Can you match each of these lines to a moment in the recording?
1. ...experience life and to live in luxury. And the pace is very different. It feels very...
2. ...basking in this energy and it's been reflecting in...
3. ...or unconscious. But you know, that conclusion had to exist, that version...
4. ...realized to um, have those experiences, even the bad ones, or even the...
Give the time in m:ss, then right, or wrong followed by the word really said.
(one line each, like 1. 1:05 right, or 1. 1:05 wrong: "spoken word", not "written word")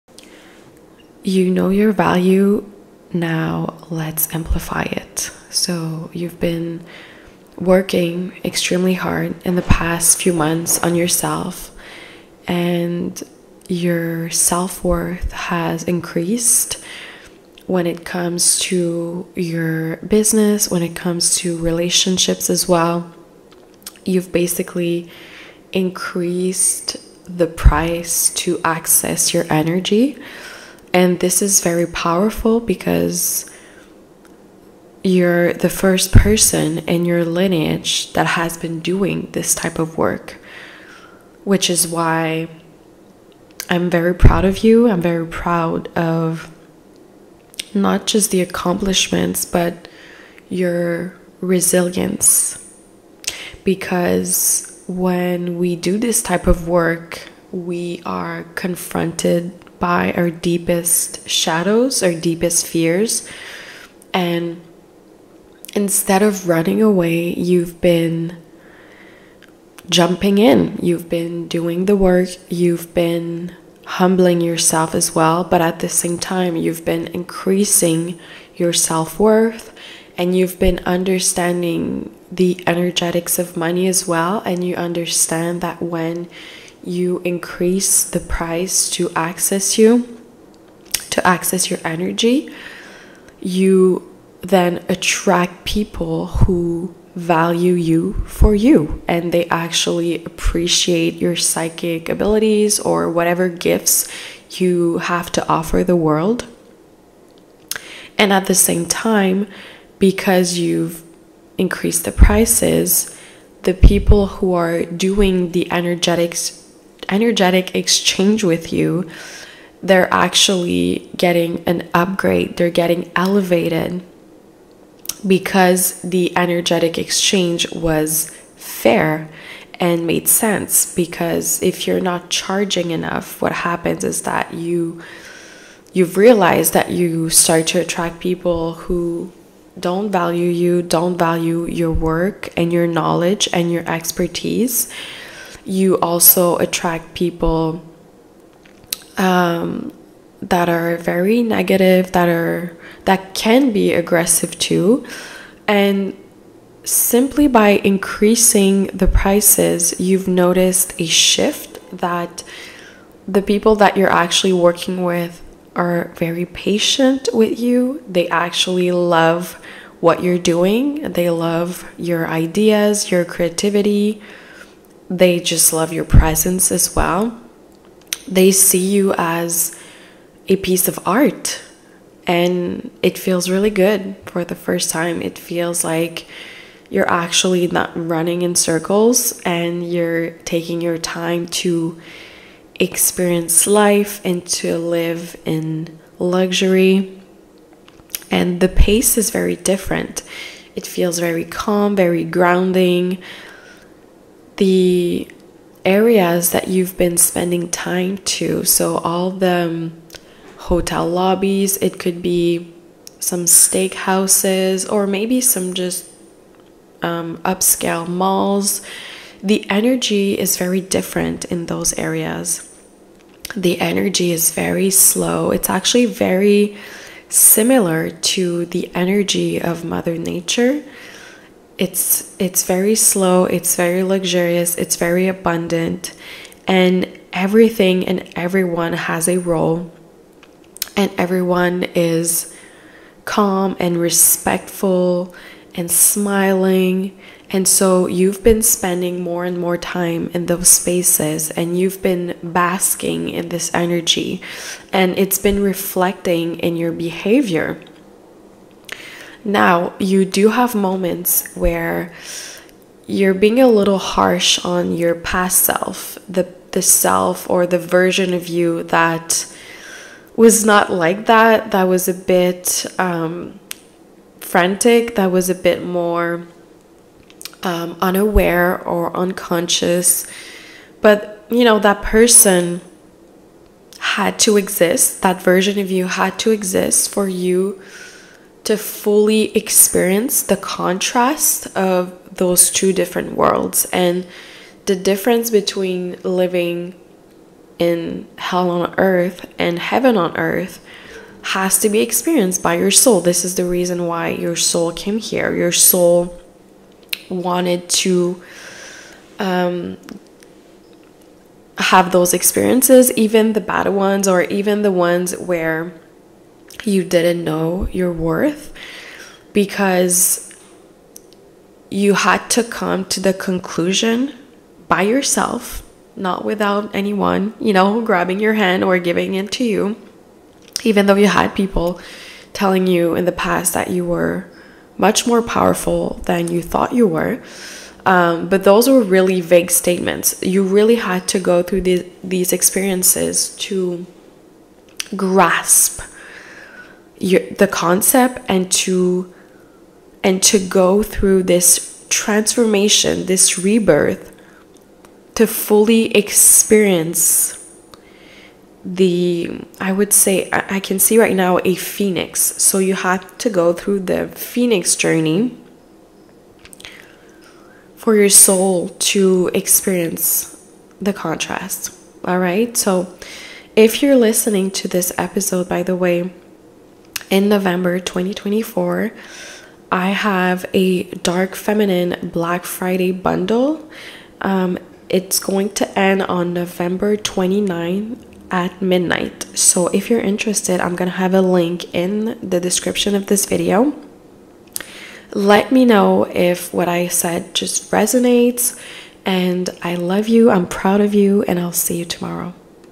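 1. 3:12 right
2. 4:12 right
3. 4:38 wrong: "person", not "conclusion"
4. 5:07 wrong: "wanted", not "realized".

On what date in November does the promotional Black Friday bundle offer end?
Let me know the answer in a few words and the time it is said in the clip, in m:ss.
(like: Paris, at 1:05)
November 29, at 6:26.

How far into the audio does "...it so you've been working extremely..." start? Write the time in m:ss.
0:04.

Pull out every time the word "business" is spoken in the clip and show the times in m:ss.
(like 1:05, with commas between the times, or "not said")
0:19.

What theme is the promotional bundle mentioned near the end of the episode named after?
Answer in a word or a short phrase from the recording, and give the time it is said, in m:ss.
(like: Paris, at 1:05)
Dark feminine, at 6:21.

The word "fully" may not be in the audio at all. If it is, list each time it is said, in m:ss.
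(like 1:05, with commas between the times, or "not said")
4:48, 5:55.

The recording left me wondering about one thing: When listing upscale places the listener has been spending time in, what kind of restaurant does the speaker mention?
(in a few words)
Steakhouses.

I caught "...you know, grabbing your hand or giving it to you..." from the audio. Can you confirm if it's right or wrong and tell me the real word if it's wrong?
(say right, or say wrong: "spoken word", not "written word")
right.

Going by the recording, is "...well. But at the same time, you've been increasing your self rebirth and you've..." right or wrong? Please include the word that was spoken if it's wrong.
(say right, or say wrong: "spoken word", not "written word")
wrong: "worth", not "rebirth".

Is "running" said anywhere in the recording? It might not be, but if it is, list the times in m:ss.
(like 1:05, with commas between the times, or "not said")
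1:06, 3:07.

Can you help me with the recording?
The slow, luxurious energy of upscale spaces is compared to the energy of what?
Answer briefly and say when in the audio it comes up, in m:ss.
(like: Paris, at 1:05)
Mother Nature, at 3:49.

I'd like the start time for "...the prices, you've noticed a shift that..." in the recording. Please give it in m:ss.
2:38.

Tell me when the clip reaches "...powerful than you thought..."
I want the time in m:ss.
5:35.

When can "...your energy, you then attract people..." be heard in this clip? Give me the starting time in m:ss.
1:31.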